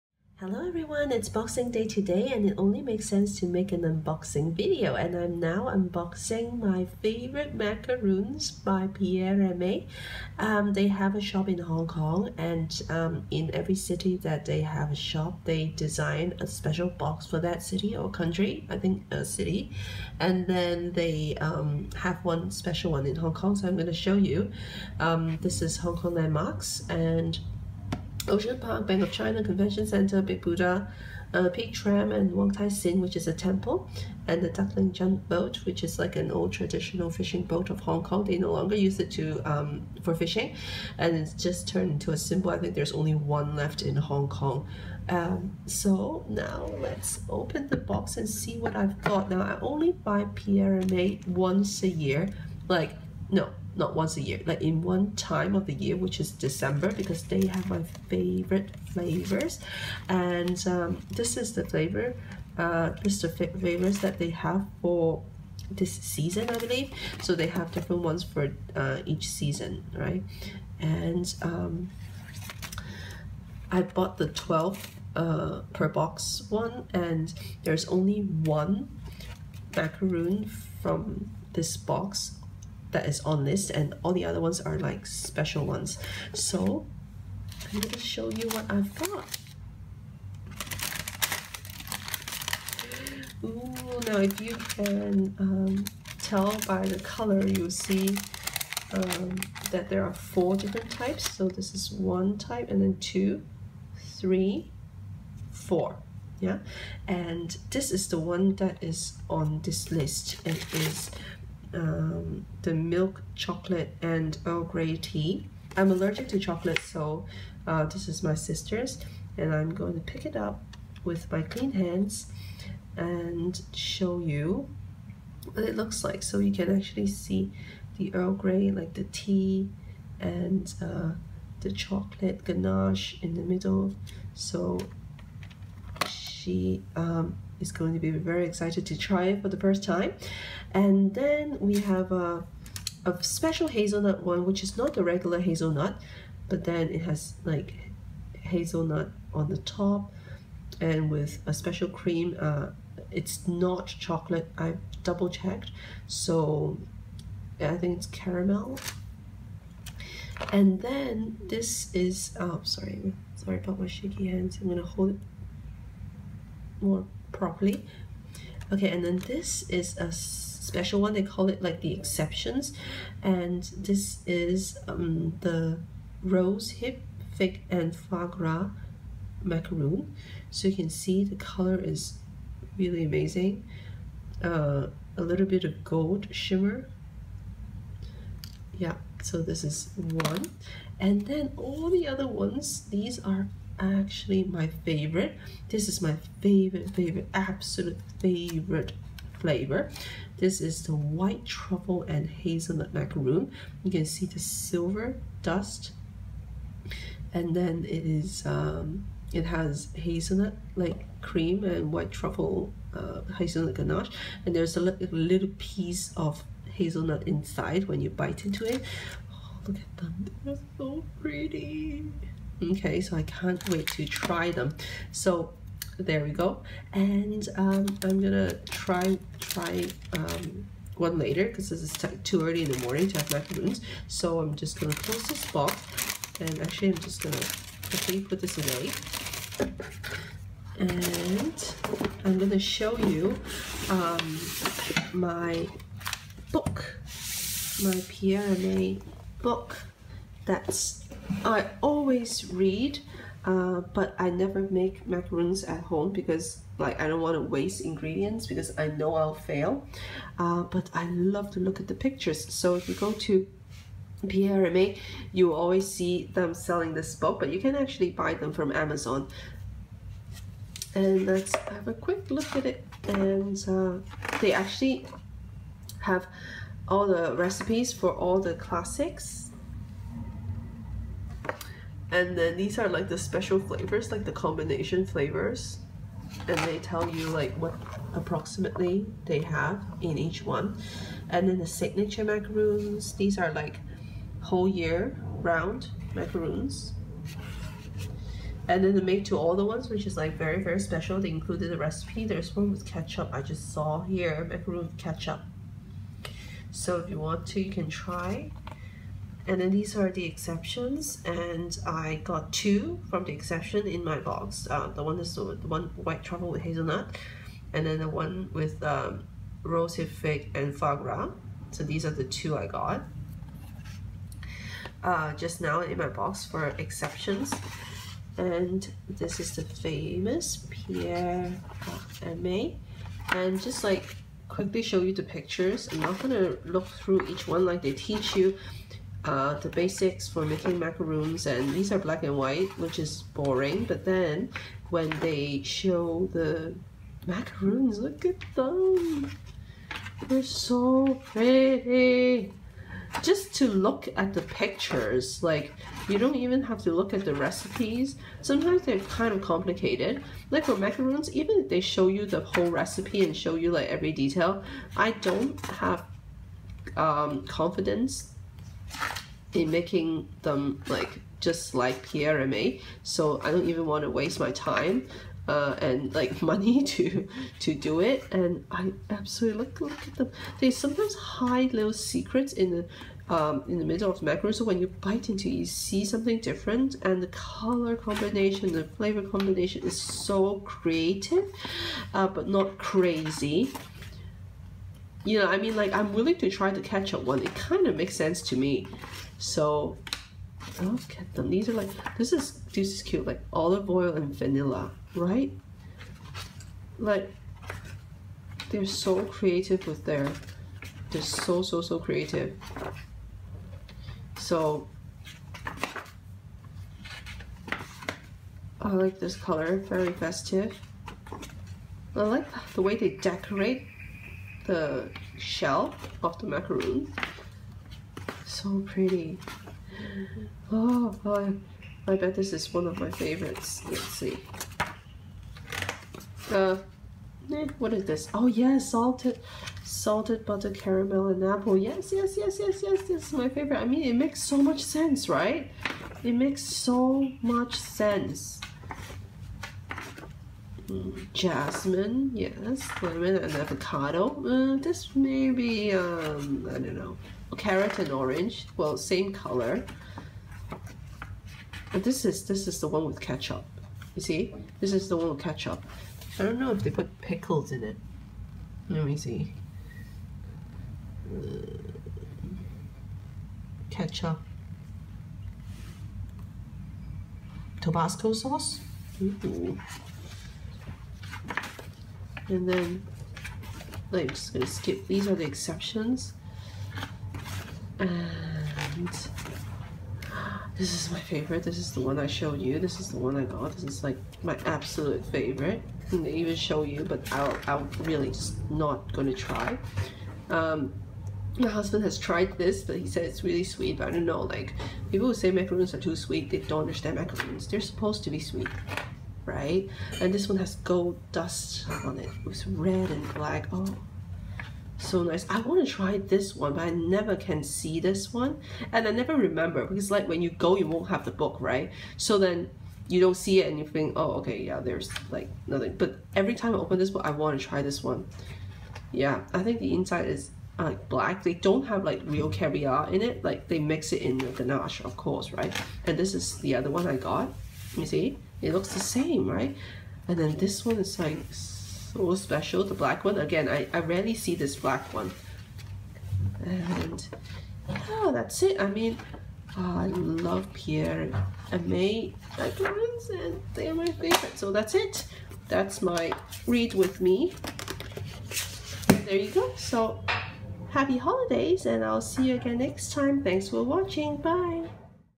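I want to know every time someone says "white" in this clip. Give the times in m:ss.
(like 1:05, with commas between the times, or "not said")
3:20, 3:31, 5:15, 5:42.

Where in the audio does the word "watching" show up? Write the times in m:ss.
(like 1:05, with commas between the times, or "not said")
9:23.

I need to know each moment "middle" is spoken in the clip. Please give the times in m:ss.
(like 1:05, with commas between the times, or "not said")
2:13, 6:23.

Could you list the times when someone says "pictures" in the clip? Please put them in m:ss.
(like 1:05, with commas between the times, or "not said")
4:21, 5:35, 5:54.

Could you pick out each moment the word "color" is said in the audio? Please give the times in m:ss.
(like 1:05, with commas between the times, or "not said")
1:36, 3:01, 6:27, 6:59, 7:39.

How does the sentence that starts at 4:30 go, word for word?
And let's have a quick look at it.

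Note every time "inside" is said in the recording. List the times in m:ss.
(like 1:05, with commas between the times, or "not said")
3:37, 8:49.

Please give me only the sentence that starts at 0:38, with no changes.
They no longer use it to um, for fishing, and it's just turned into a symbol.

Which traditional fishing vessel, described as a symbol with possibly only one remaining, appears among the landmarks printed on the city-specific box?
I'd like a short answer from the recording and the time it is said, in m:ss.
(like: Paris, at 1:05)
Duk Ling Junk Boat, at 0:34.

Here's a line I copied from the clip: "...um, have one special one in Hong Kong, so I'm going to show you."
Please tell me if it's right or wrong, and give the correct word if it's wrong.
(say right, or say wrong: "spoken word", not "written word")
right.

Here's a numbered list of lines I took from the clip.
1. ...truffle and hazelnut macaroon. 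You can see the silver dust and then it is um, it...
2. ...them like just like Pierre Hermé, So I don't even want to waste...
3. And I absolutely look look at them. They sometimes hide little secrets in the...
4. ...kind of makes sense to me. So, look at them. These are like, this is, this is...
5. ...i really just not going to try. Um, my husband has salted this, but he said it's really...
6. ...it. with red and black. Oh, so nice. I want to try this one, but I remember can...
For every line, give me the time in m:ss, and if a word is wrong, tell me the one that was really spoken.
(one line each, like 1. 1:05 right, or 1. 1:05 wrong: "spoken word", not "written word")
1. 3:21 right
2. 6:10 right
3. 6:18 right
4. 6:37 right
5. 8:17 wrong: "tried", not "salted"
6. 8:32 wrong: "never", not "remember".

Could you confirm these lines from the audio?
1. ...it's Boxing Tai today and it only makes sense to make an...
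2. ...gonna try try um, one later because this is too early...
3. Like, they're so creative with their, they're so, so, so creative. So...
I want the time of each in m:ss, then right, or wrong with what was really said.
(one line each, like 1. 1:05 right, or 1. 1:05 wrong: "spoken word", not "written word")
1. 0:01 wrong: "Day", not "Tai"
2. 3:48 right
3. 6:46 right.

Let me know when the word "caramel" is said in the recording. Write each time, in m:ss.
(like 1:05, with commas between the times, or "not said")
2:38, 7:20.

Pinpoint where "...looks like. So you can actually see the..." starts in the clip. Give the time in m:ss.
2:05.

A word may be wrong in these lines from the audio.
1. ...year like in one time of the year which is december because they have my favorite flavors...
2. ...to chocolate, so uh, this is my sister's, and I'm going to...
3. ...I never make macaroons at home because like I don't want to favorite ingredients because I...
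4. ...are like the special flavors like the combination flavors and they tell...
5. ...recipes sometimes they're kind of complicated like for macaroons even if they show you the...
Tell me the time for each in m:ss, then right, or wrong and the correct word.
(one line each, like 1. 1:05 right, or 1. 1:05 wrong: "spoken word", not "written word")
1. 0:54 right
2. 1:56 right
3. 4:14 wrong: "waste", not "favorite"
4. 4:42 right
5. 5:57 right.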